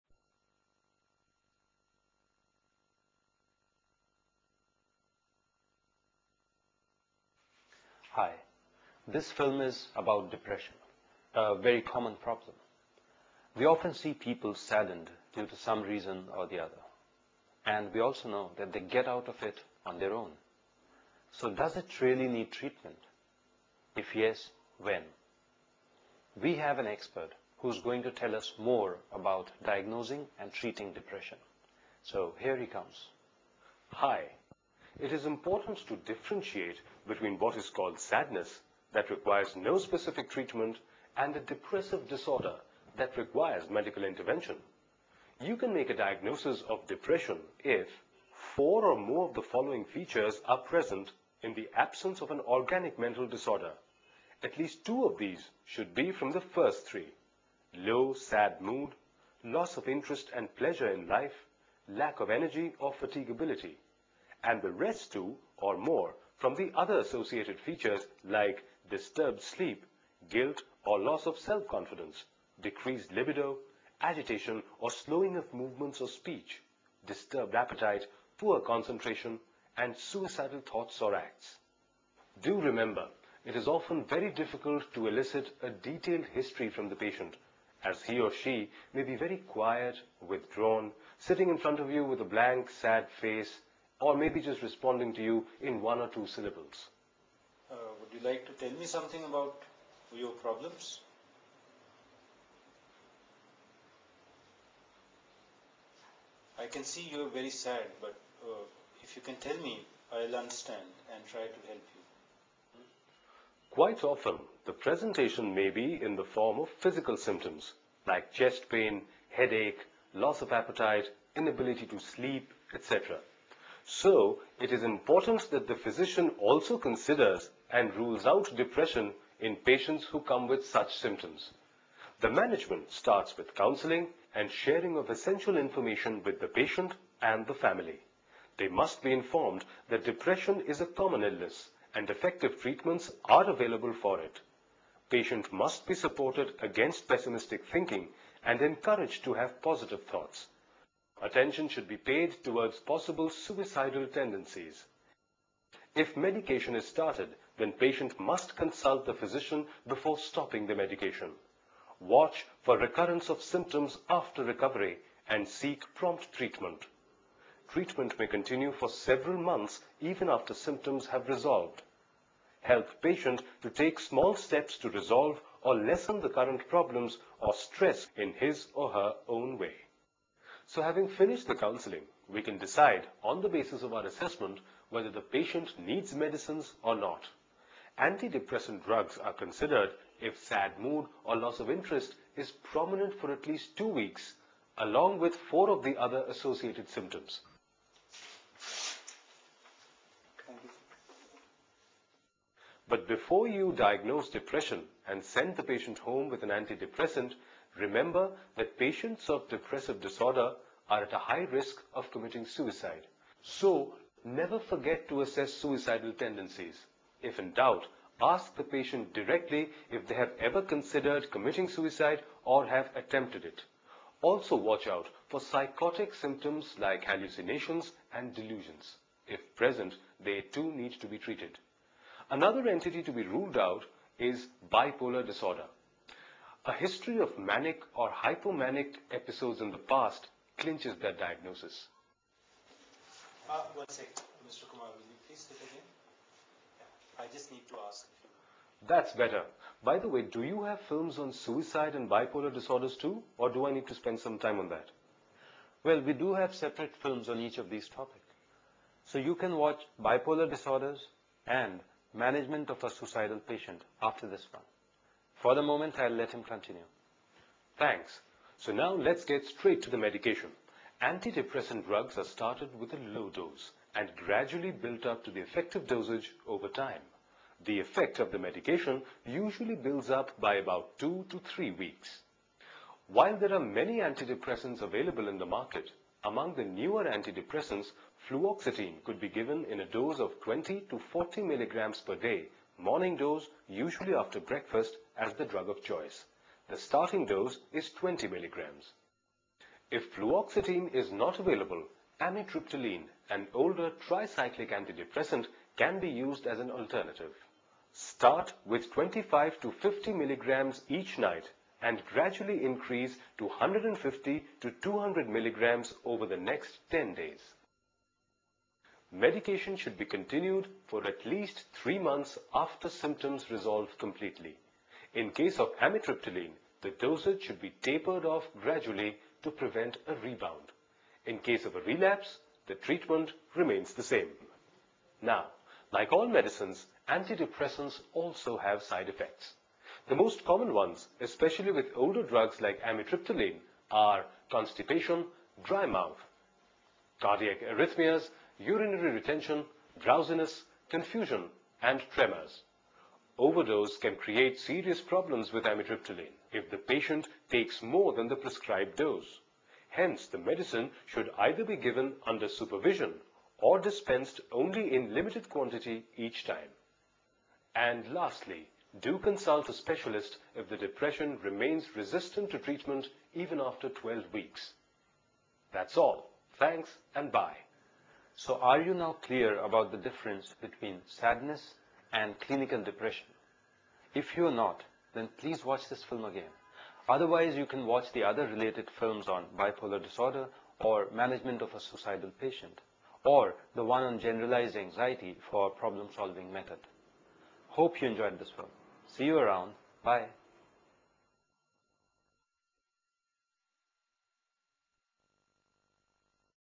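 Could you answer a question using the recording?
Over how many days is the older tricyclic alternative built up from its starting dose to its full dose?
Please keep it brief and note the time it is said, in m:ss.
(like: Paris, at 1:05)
10 days, at 5:16.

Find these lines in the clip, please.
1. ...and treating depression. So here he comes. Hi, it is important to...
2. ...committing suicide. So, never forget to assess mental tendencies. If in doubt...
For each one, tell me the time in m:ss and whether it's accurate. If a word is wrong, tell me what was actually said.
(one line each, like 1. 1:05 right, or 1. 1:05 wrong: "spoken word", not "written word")
1. 0:30 right
2. 3:32 wrong: "suicidal", not "mental".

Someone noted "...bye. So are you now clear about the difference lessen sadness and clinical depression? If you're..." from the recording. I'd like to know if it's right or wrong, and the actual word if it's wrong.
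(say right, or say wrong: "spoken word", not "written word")
wrong: "between", not "lessen".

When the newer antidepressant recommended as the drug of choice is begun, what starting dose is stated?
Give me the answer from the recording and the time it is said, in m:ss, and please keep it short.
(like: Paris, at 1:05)
20 milligrams, at 4:57.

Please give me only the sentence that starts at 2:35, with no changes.
If medication is started, then patient must consult the physician before stopping the medication.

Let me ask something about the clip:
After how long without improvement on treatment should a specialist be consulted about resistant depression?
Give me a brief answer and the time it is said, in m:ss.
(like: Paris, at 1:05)
12 weeks, at 6:13.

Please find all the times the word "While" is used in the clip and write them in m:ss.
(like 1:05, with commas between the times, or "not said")
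4:43.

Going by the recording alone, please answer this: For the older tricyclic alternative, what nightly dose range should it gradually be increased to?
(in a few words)
150 to 200 milligrams.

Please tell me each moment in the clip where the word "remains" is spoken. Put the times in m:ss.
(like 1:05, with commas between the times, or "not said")
5:33, 6:11.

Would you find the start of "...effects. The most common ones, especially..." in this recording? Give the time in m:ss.
5:39.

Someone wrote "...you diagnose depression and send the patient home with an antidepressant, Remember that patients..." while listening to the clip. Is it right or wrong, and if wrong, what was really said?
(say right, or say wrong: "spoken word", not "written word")
right.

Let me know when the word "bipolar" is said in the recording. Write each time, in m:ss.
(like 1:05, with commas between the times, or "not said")
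3:54, 4:12, 4:19, 6:29.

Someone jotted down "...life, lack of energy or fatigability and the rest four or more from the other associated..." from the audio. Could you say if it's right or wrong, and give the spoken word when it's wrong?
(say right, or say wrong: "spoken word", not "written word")
wrong: "two", not "four".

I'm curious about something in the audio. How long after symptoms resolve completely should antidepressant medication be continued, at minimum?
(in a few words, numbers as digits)
3 months.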